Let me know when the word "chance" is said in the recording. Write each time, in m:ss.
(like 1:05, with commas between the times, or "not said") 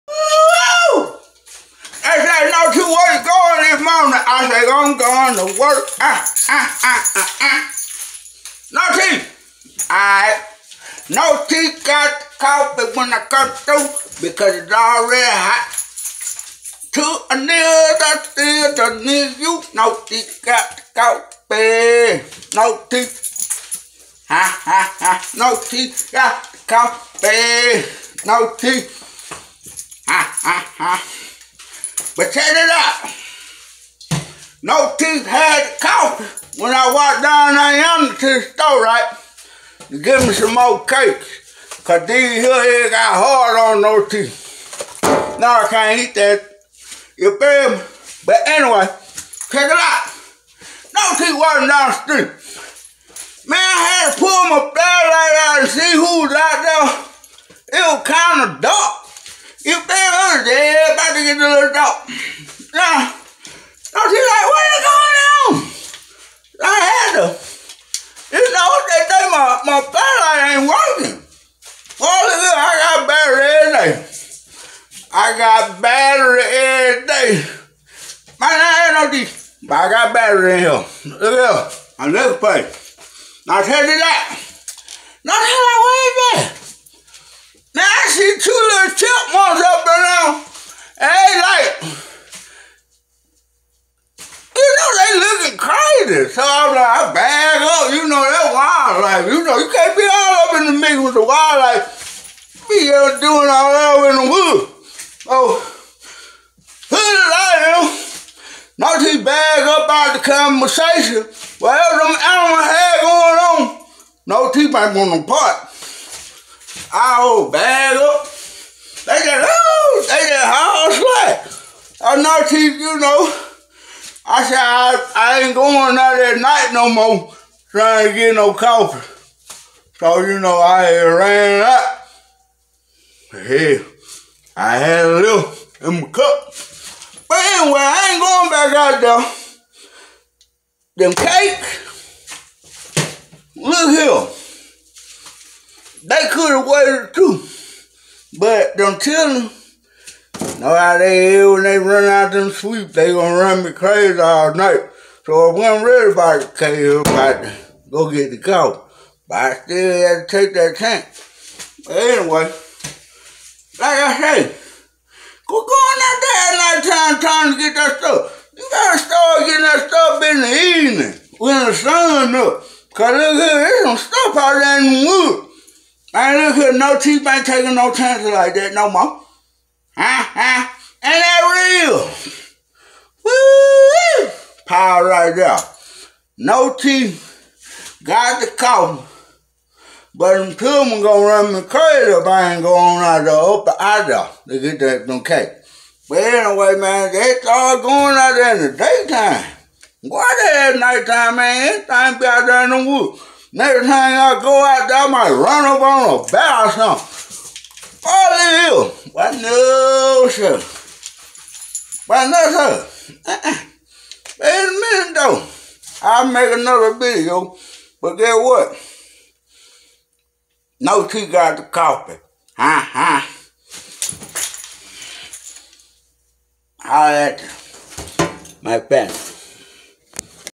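2:40, 2:57.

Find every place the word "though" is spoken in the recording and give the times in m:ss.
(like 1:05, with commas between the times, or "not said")
3:35.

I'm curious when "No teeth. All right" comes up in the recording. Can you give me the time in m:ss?
0:08.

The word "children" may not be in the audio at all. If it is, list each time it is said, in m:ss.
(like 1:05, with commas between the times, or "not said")
2:28, 3:10.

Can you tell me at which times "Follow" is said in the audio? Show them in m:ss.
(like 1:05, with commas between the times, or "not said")
3:28.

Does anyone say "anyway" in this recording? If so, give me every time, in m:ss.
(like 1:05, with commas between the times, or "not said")
0:48, 2:17, 2:41, 3:16.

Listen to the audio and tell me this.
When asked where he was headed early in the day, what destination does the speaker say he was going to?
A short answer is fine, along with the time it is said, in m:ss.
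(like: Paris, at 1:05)
work, at 0:05.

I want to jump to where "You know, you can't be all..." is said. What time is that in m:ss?
1:39.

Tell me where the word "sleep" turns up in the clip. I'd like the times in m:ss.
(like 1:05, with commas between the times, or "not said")
2:32.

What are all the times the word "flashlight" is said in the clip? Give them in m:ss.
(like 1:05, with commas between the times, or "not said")
0:54, 1:09.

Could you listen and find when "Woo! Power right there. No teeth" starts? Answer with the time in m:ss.
3:03.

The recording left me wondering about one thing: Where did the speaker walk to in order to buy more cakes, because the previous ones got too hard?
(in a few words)
the store.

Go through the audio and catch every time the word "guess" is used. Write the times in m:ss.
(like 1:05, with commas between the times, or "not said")
3:38.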